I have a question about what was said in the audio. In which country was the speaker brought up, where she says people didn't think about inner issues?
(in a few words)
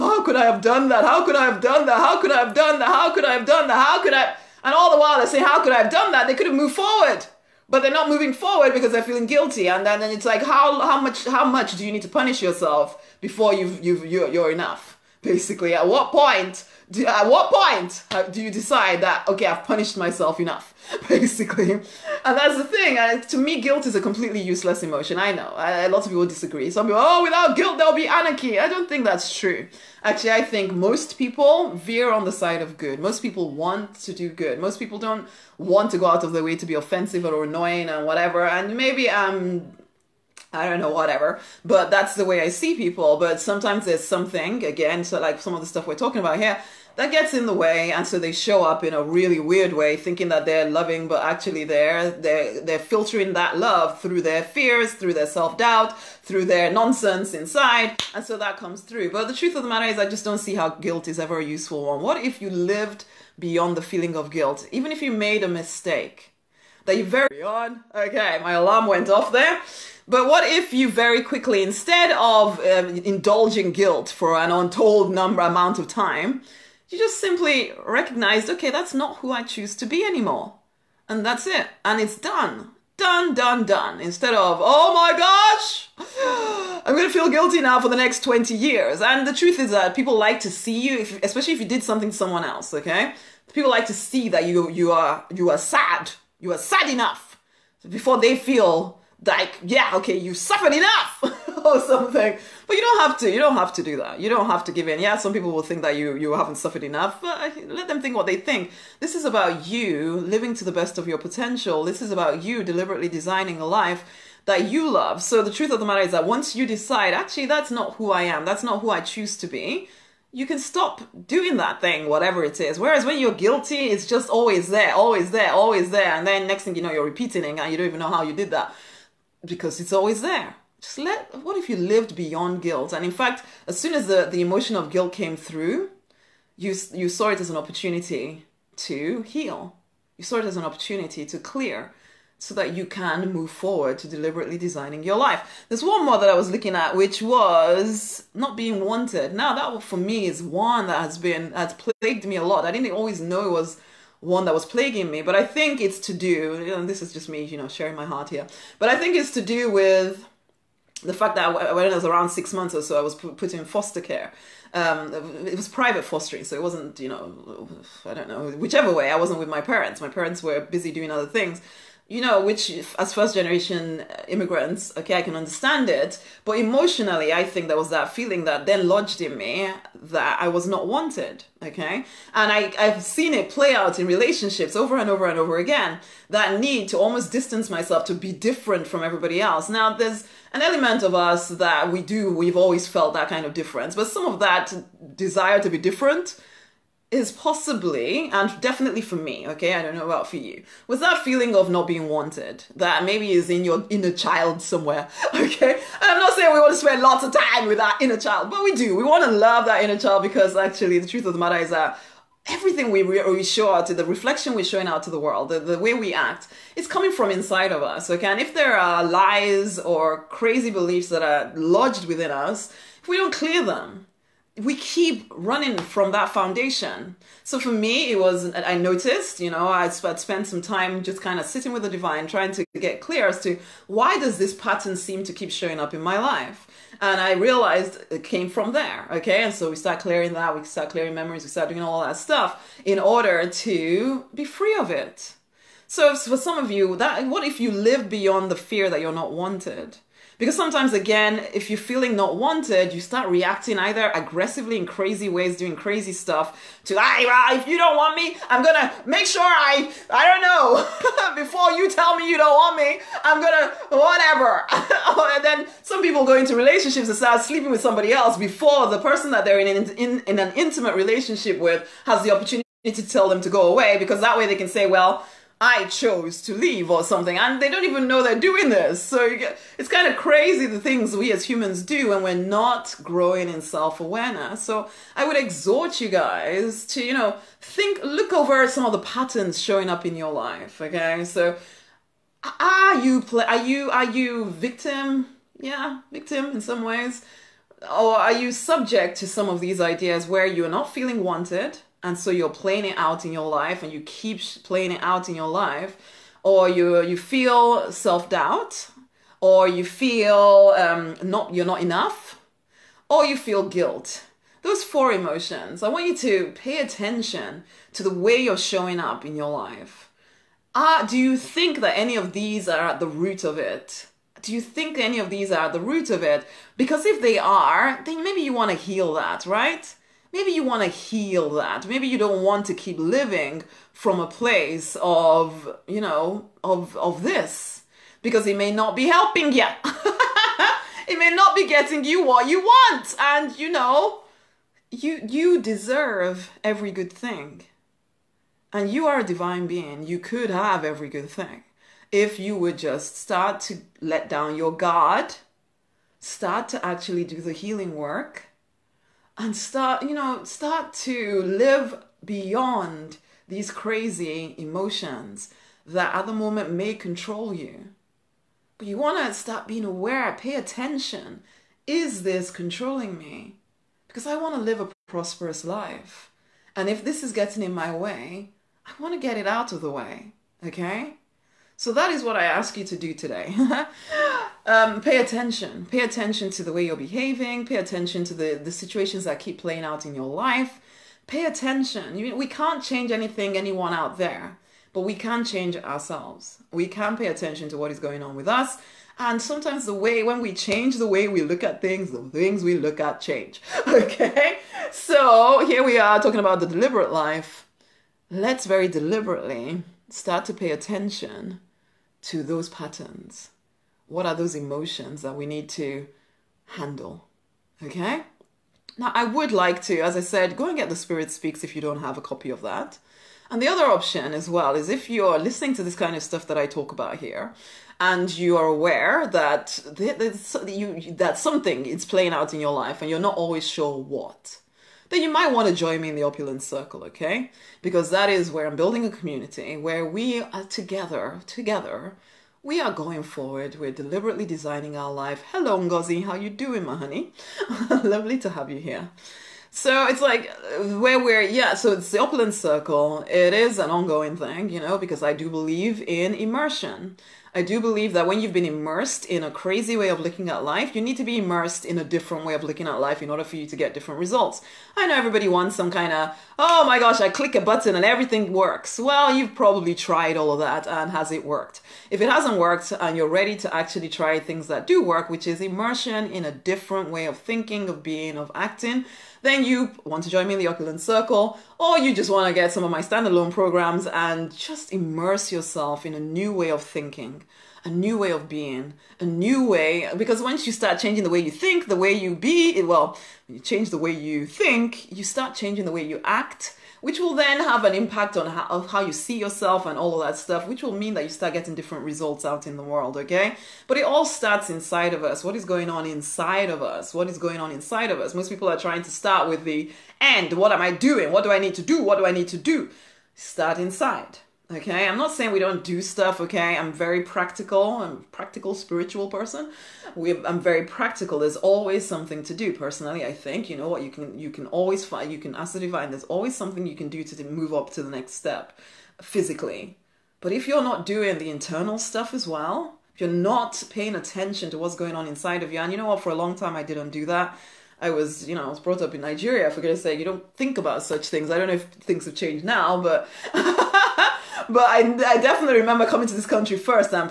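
Nigeria.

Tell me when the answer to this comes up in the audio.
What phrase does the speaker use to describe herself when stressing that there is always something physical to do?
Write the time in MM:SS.
08:38.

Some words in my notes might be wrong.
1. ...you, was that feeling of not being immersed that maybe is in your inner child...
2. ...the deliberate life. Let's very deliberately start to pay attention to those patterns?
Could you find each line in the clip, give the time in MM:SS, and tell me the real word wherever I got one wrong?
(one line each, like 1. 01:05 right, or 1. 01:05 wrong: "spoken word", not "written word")
1. 03:20 wrong: "wanted", not "immersed"
2. 06:46 right.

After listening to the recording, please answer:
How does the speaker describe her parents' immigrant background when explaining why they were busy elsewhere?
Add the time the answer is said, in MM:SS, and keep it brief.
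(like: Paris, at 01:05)
first generation, at 02:53.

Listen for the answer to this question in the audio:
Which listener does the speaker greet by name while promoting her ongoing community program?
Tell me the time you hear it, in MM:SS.
07:25.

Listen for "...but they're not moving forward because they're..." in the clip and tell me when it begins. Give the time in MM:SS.
00:07.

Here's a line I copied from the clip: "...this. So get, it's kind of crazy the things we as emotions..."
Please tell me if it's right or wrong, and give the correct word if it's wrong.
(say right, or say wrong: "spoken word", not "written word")
wrong: "humans", not "emotions".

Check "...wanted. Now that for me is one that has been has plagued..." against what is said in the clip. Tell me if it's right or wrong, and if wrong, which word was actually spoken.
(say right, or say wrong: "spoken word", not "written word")
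right.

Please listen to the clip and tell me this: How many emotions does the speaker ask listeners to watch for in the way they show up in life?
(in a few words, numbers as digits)
4.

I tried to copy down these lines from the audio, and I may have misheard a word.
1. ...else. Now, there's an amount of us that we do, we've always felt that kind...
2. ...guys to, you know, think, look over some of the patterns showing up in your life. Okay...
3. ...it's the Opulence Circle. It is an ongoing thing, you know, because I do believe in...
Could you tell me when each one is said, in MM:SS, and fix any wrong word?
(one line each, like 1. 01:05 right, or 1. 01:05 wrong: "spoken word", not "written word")
1. 03:09 wrong: "element", not "amount"
2. 04:46 right
3. 07:31 right.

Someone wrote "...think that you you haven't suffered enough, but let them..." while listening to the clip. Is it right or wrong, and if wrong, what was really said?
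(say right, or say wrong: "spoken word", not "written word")
right.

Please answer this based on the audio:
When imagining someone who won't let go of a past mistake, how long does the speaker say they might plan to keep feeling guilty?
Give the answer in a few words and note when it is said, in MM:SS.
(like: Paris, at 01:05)
20 years, at 01:28.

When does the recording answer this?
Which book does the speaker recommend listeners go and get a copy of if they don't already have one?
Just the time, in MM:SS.
07:00.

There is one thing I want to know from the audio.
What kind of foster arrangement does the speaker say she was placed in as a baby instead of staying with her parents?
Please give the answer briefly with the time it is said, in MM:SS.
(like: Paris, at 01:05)
private fostering, at 02:45.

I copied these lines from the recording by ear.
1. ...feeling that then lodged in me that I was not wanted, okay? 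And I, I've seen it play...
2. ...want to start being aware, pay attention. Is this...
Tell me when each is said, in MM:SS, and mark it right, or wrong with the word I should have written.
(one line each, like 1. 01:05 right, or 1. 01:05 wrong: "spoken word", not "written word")
1. 02:58 right
2. 06:08 right.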